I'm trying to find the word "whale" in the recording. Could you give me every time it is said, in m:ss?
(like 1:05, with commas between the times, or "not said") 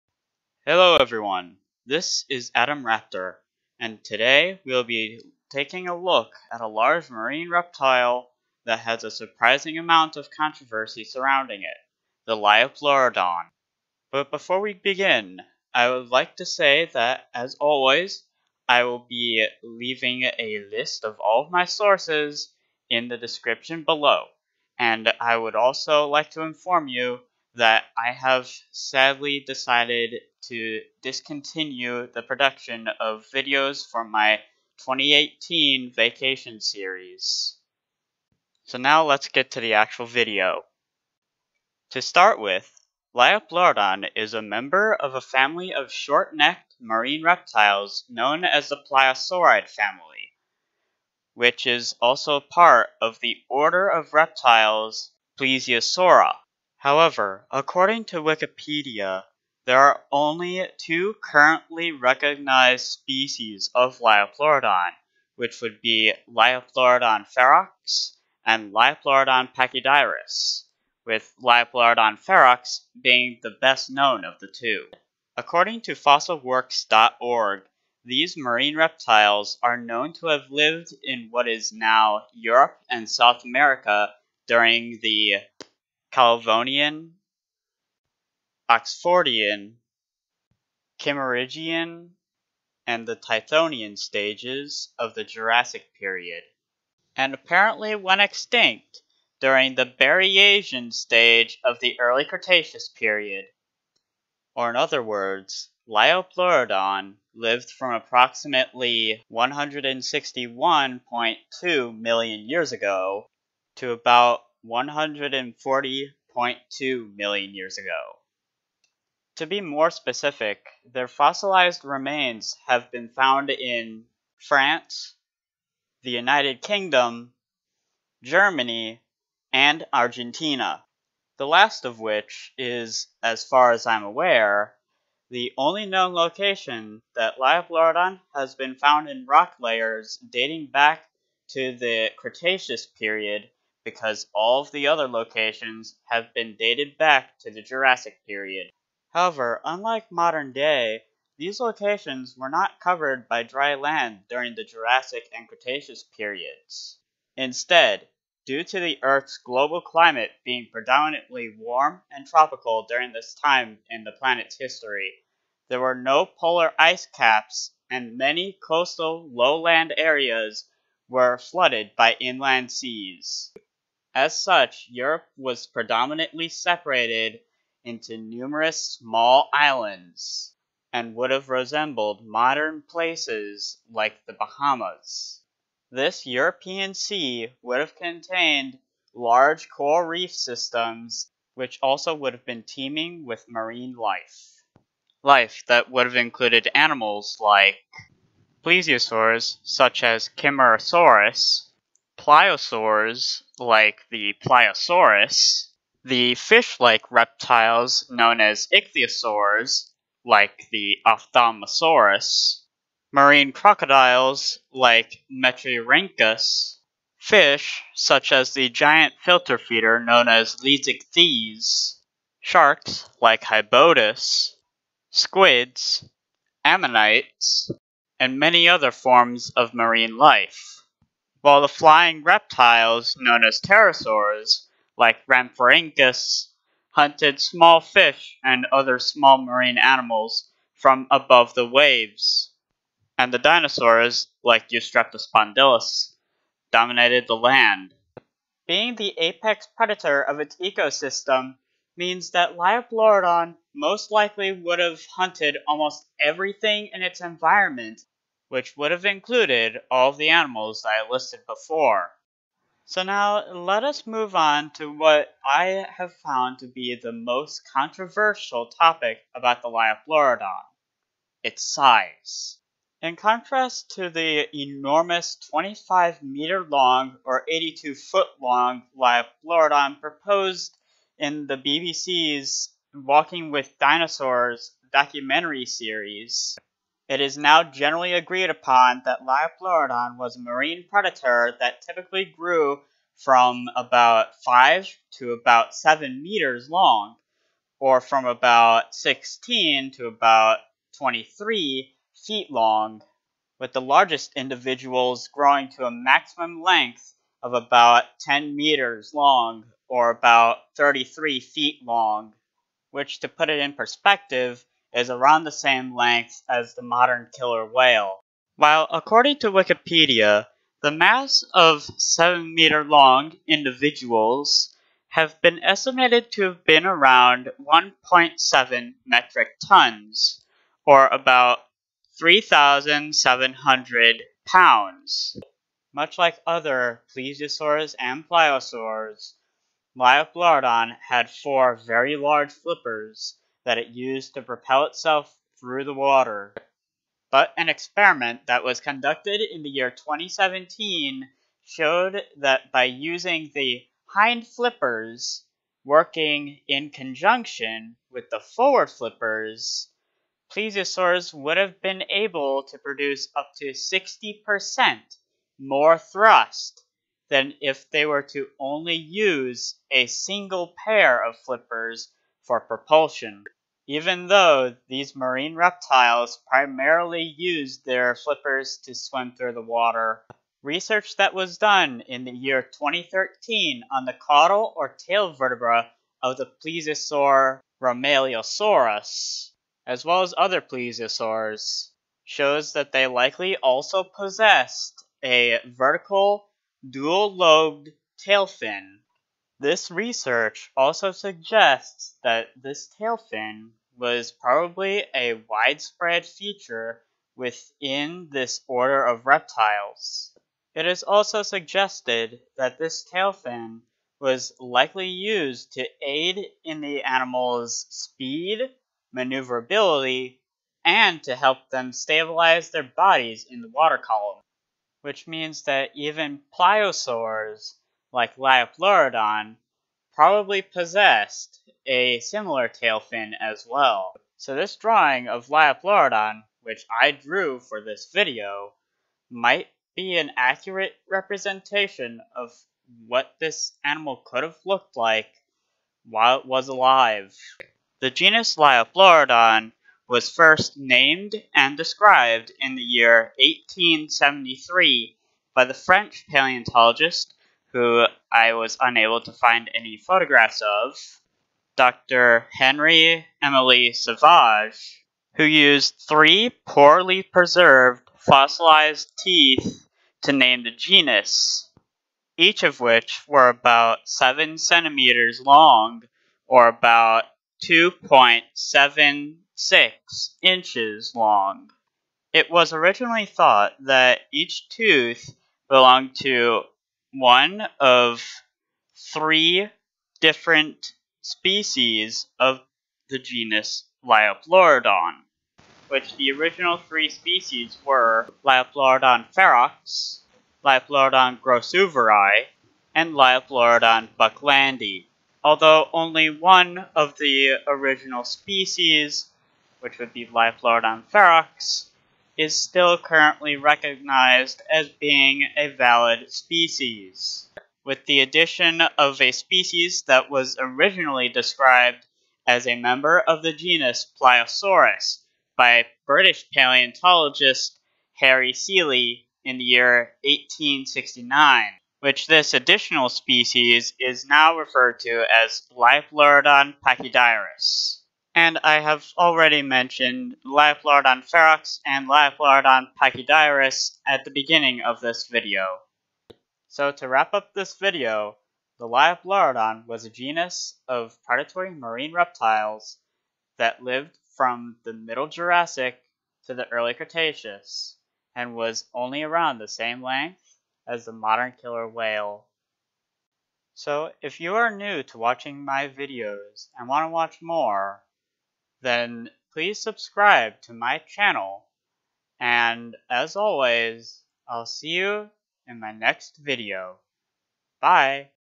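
5:17, 9:21.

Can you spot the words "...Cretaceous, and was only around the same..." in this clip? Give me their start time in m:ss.
9:16.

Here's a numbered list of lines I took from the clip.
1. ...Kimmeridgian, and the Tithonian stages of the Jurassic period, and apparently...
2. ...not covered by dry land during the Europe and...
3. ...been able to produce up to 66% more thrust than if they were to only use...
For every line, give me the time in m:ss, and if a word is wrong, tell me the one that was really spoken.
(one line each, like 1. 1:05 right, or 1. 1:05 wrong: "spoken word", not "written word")
1. 1:30 right
2. 2:32 wrong: "Jurassic", not "Europe"
3. 6:01 wrong: "60", not "66".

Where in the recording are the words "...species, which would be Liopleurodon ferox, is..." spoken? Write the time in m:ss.
8:28.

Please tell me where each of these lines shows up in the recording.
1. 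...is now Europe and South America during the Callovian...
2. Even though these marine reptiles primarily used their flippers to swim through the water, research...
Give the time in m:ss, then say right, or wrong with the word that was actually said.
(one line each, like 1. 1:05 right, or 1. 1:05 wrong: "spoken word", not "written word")
1. 1:21 right
2. 6:13 right.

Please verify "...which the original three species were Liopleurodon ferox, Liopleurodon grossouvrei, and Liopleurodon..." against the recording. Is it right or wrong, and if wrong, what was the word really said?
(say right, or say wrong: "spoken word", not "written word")
right.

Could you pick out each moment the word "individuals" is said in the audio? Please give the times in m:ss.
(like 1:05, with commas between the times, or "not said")
5:04, 5:23.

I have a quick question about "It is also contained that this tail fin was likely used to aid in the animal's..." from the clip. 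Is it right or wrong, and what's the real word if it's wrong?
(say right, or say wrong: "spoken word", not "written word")
wrong: "suggested", not "contained".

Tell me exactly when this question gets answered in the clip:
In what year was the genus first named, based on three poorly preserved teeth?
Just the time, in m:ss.
7:33.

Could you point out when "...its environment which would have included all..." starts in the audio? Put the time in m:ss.
4:17.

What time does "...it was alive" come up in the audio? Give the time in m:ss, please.
7:26.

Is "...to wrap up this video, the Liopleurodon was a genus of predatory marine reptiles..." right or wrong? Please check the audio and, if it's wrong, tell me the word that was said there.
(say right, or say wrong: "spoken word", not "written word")
right.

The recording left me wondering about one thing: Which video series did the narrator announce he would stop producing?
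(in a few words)
2018 vacation series.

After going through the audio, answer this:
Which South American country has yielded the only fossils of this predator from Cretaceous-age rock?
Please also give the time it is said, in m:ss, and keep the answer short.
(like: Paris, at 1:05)
Argentina, at 2:09.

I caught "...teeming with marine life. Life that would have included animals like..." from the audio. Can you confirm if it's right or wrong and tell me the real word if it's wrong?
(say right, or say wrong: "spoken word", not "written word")
right.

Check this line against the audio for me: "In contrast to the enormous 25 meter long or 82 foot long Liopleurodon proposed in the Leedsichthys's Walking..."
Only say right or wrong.
wrong.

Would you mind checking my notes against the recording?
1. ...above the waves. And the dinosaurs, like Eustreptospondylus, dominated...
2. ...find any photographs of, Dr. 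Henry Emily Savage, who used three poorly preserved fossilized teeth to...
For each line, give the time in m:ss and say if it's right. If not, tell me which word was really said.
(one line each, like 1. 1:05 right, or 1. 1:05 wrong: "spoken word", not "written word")
1. 4:01 right
2. 7:39 right.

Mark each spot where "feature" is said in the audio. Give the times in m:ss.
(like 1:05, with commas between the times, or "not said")
6:46.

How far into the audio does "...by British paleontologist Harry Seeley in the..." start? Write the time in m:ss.
8:45.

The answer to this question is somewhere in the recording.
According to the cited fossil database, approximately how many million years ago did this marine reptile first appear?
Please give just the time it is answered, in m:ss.
1:49.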